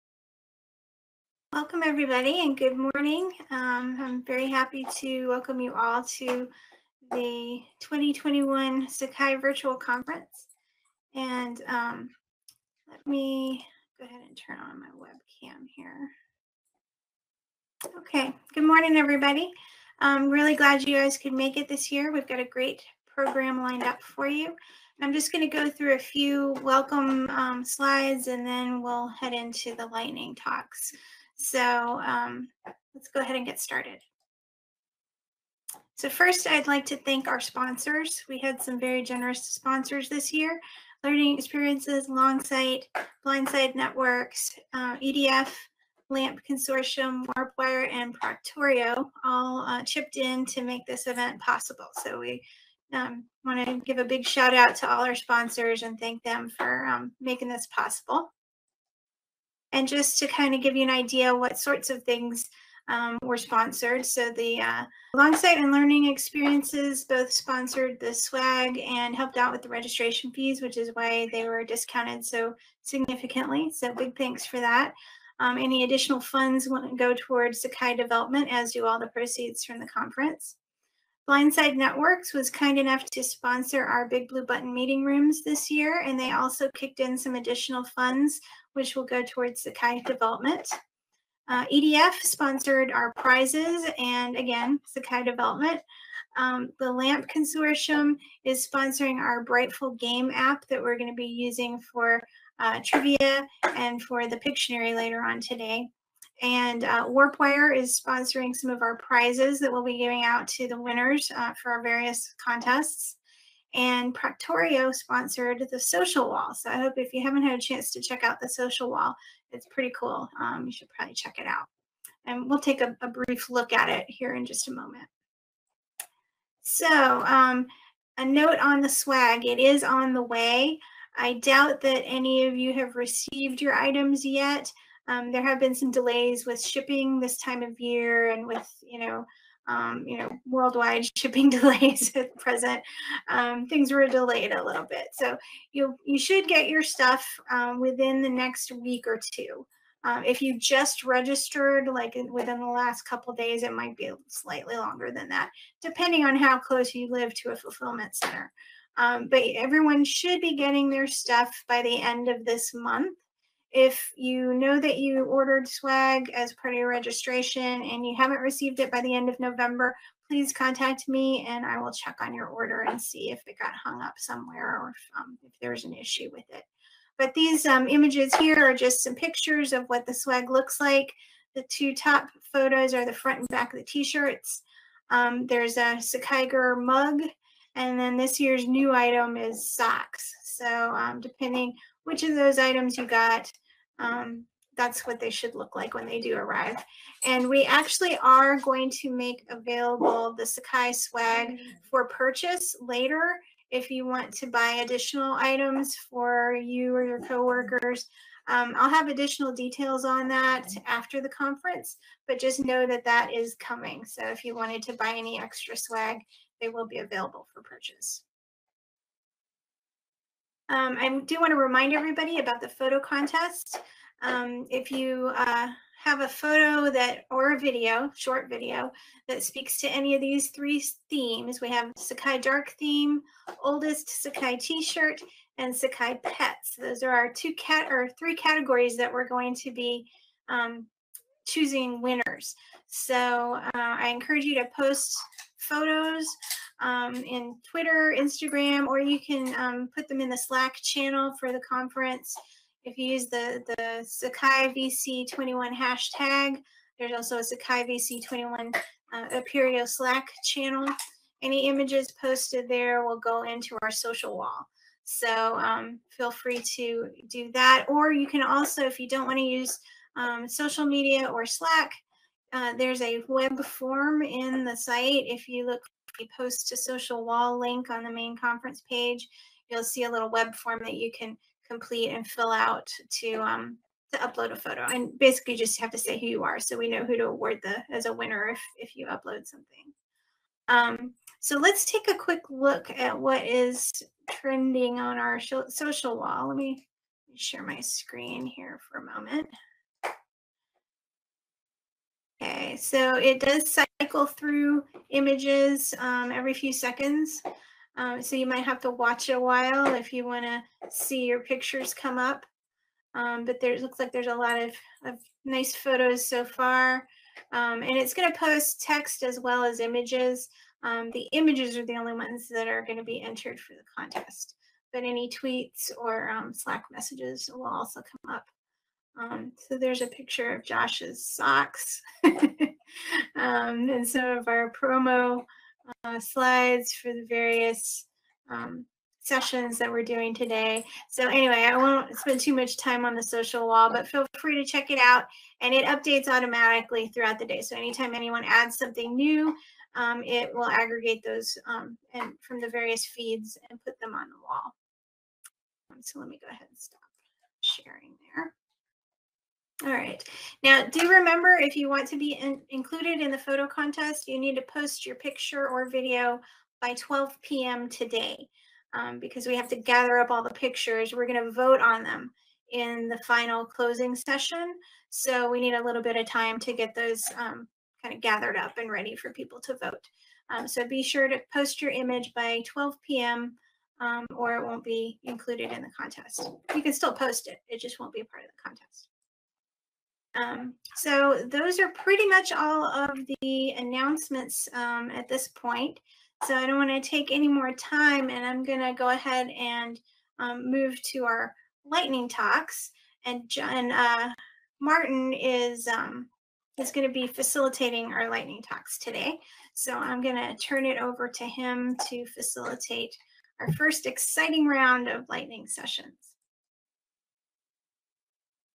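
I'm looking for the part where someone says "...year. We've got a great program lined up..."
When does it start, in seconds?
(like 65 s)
21 s.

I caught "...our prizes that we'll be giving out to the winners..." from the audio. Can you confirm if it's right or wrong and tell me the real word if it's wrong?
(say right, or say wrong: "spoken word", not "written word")
right.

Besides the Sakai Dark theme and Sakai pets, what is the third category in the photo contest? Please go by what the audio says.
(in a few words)
oldest Sakai t-shirt.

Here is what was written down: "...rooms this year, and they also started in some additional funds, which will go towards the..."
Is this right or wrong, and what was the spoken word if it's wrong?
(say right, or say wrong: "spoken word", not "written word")
wrong: "kicked", not "started".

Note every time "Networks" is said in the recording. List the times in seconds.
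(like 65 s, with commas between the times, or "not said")
43 s, 81 s.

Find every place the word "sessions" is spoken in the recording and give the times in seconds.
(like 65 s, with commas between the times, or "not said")
339 s, 374 s, 415 s.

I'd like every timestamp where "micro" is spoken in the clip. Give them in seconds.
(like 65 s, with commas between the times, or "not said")
not said.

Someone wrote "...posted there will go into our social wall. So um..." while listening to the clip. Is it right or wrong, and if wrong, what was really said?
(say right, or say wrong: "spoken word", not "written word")
right.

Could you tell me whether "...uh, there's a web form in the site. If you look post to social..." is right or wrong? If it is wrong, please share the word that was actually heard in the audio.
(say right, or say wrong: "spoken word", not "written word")
right.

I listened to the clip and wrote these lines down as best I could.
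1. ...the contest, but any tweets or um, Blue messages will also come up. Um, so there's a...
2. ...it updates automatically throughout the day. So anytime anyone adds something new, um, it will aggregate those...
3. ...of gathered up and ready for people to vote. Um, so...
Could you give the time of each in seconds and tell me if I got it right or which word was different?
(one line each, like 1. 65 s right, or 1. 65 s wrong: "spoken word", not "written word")
1. 323 s wrong: "Slack", not "Blue"
2. 345 s right
3. 378 s right.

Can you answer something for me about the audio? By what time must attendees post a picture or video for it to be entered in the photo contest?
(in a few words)
12 p.m.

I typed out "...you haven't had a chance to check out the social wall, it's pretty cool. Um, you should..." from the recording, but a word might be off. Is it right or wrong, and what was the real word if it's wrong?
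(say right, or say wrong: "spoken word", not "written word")
right.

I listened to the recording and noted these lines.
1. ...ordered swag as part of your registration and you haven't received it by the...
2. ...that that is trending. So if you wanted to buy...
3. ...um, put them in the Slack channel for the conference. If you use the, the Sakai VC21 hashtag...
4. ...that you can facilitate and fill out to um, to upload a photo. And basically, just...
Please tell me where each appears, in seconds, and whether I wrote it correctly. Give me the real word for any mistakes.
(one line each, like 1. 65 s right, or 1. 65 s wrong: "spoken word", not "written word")
1. 165 s right
2. 212 s wrong: "coming", not "trending"
3. 249 s right
4. 280 s wrong: "complete", not "facilitate".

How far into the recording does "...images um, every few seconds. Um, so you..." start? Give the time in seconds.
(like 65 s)
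305 s.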